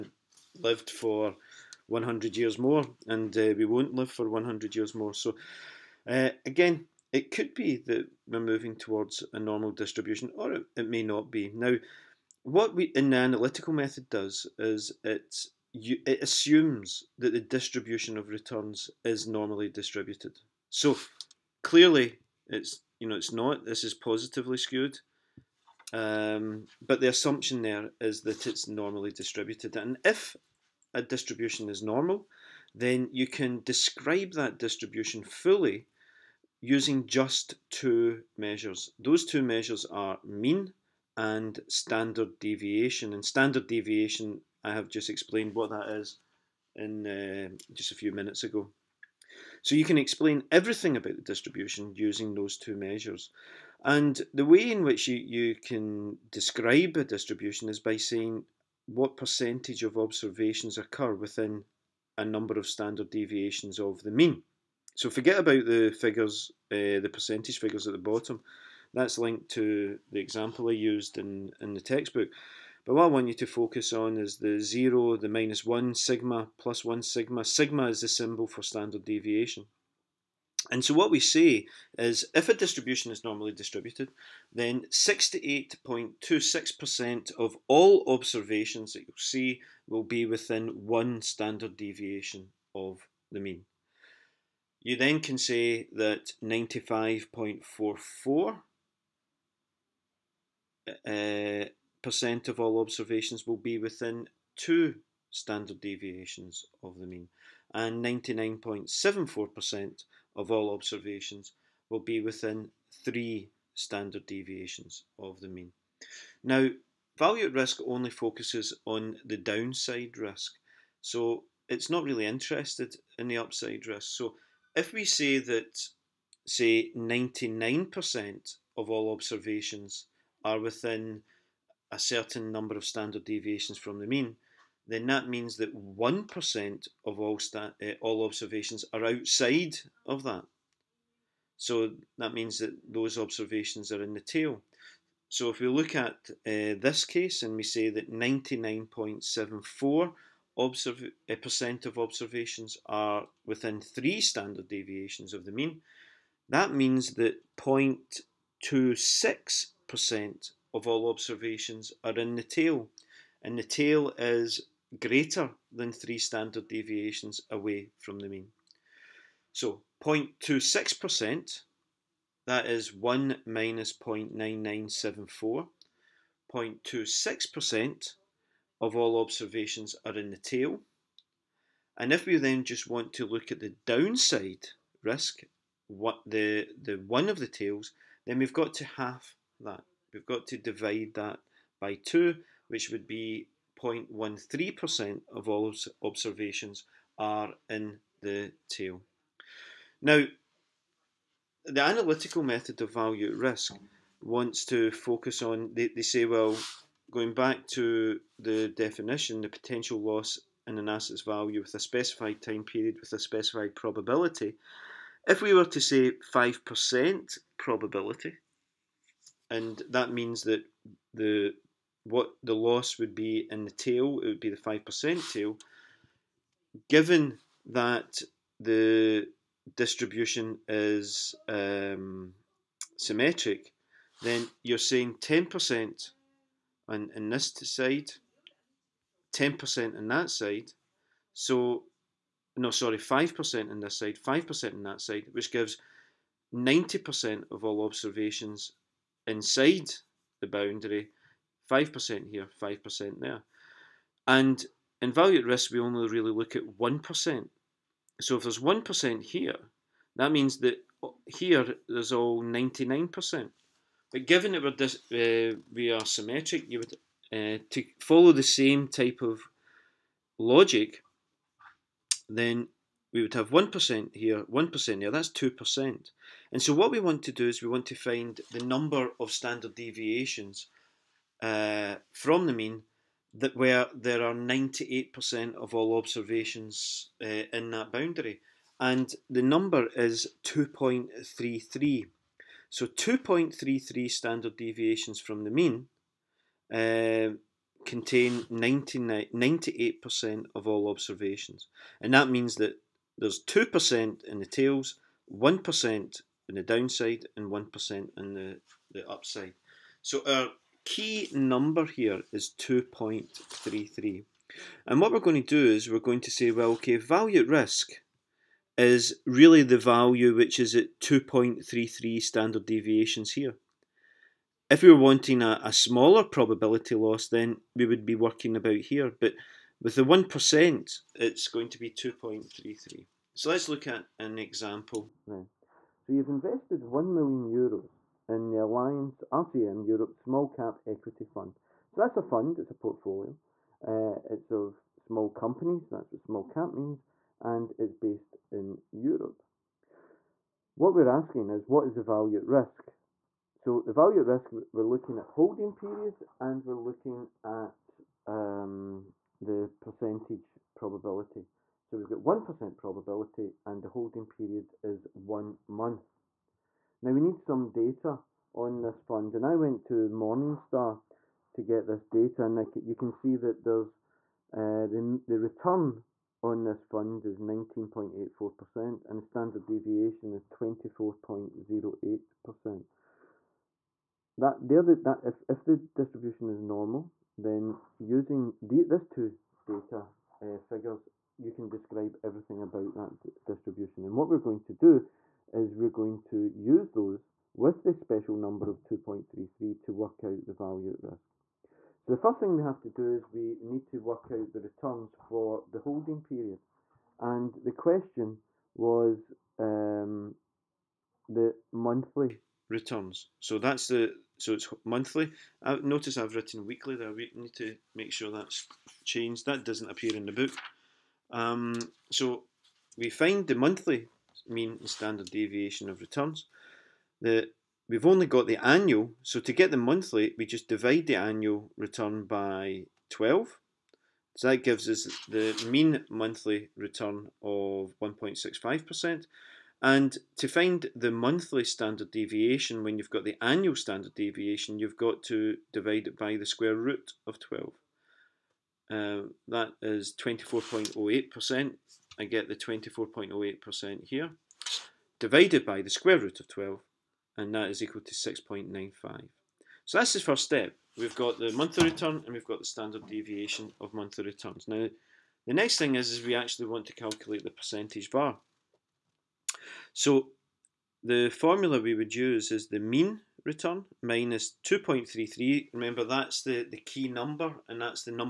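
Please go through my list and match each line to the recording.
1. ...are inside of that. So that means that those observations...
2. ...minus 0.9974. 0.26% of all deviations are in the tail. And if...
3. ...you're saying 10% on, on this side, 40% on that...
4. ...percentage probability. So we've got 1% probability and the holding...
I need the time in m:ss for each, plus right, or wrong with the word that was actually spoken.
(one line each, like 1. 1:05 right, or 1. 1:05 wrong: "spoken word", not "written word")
1. 2:18 wrong: "outside", not "inside"
2. 2:53 wrong: "observations", not "deviations"
3. 3:54 wrong: "10", not "40"
4. 5:59 right.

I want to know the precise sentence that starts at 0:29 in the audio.
And if a distribution is normal, then you can describe that distribution fully using just two measures.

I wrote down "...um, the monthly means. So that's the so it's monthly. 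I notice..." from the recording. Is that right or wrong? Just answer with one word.
wrong.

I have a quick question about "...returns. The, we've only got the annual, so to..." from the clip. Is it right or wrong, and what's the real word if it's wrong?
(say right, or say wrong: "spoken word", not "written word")
right.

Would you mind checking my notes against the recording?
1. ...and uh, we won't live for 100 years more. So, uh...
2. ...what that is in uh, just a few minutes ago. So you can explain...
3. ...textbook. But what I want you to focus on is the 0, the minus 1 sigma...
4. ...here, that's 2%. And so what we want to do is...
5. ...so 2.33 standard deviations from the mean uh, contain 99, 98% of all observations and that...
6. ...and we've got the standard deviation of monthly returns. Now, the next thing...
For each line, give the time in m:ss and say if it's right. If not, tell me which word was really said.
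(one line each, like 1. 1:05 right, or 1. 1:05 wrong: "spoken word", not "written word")
1. 0:03 right
2. 0:45 right
3. 1:11 right
4. 4:35 right
5. 4:52 right
6. 7:42 right.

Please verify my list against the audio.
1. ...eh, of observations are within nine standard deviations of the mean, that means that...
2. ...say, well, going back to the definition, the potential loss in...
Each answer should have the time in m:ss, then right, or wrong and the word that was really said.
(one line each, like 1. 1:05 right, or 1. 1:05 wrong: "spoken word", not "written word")
1. 2:31 wrong: "three", not "nine"
2. 3:26 right.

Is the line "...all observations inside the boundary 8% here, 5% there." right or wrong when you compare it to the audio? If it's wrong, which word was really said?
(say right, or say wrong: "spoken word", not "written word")
wrong: "5", not "8".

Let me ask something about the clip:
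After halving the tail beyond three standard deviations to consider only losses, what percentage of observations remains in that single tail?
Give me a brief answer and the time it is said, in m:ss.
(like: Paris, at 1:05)
0.13%, at 3:13.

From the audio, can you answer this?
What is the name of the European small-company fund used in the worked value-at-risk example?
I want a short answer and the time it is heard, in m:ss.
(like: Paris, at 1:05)
Allianz RCM Europe Small Cap Equity Fund, at 5:38.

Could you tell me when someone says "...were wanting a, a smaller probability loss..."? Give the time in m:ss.
5:24.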